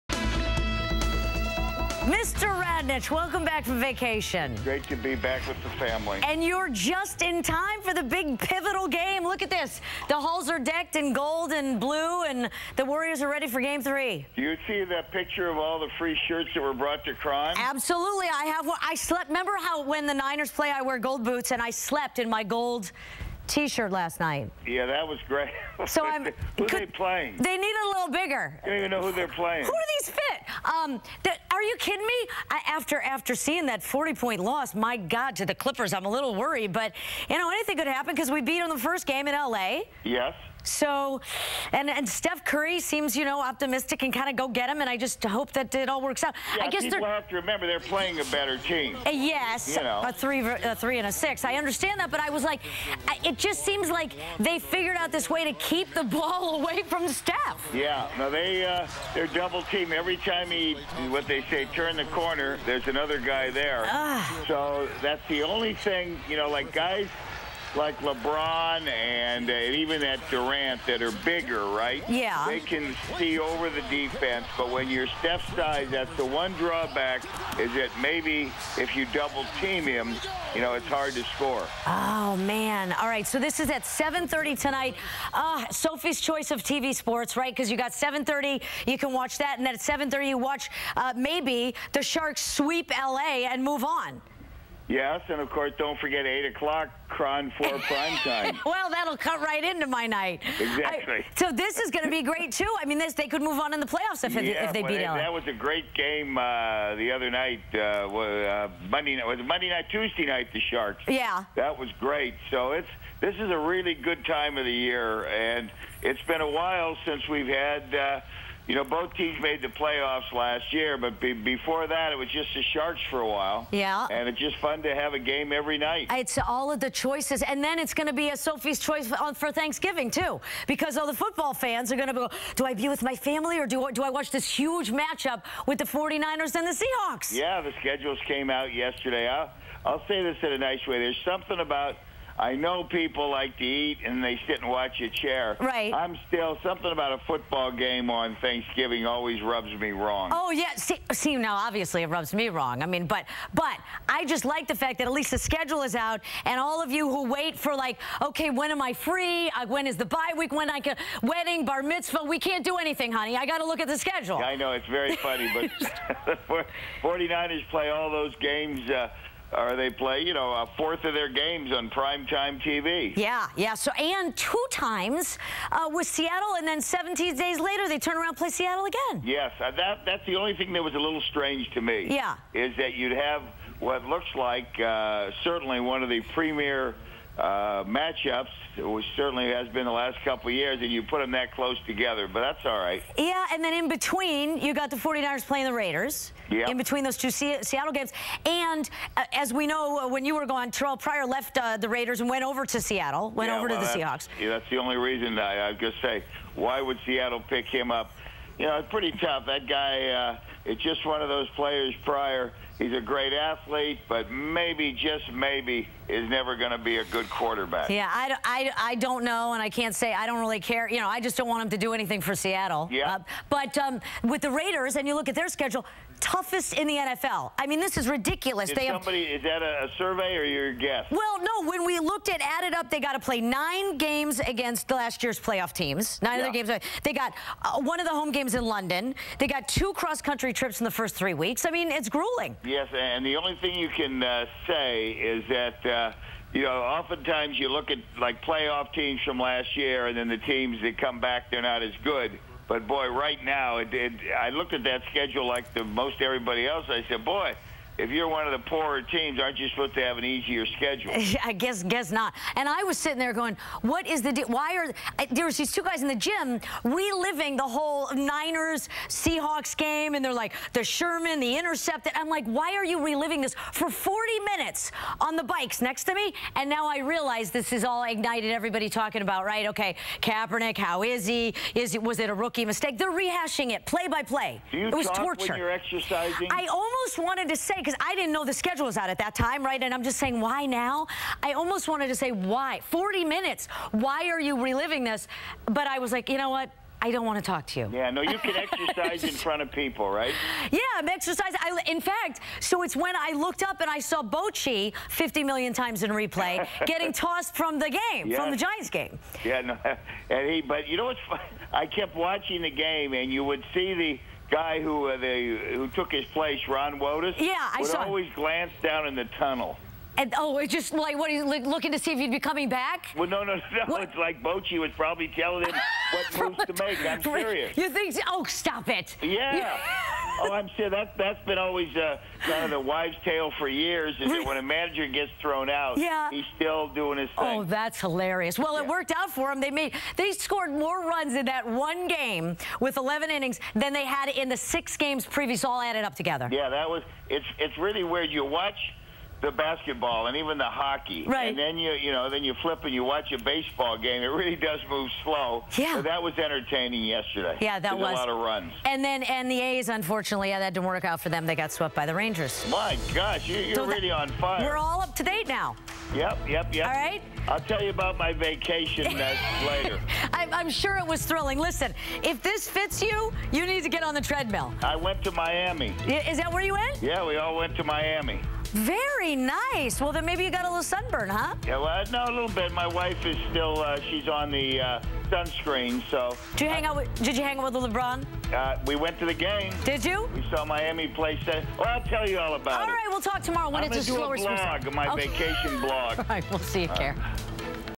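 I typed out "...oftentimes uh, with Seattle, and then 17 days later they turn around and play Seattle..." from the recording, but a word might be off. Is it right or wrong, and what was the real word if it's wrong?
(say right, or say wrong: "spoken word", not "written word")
wrong: "times", not "oftentimes".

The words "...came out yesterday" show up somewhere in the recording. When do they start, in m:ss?
2:18.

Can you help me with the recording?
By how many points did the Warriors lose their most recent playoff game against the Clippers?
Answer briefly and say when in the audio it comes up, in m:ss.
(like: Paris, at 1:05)
40, at 0:33.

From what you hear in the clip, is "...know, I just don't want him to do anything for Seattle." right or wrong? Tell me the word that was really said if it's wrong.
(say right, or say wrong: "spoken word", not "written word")
right.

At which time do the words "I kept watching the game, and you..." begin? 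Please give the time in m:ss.
5:11.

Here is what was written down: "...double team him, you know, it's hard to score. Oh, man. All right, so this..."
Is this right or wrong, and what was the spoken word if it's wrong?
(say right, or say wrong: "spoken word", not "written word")
right.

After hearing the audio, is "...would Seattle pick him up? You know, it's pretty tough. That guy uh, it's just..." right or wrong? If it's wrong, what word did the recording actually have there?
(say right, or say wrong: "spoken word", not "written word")
right.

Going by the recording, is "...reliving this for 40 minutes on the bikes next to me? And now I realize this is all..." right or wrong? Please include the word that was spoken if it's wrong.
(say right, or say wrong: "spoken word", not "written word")
right.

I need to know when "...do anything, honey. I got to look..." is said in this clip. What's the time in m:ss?
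2:42.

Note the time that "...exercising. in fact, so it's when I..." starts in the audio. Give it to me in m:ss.
5:01.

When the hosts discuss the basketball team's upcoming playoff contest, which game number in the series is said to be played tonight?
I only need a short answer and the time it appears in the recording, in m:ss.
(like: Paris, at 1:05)
Game 3, at 0:13.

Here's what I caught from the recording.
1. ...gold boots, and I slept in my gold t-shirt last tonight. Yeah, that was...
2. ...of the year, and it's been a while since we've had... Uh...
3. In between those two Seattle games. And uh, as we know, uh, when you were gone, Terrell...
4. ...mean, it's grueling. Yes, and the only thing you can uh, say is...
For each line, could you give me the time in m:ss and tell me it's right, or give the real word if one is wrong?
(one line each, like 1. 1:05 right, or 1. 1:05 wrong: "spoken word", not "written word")
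1. 0:20 wrong: "night", not "tonight"
2. 1:54 right
3. 3:16 right
4. 4:01 right.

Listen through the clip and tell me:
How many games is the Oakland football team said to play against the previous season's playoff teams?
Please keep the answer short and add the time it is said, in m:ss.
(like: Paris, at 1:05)
9, at 3:53.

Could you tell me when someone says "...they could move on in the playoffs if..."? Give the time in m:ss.
1:43.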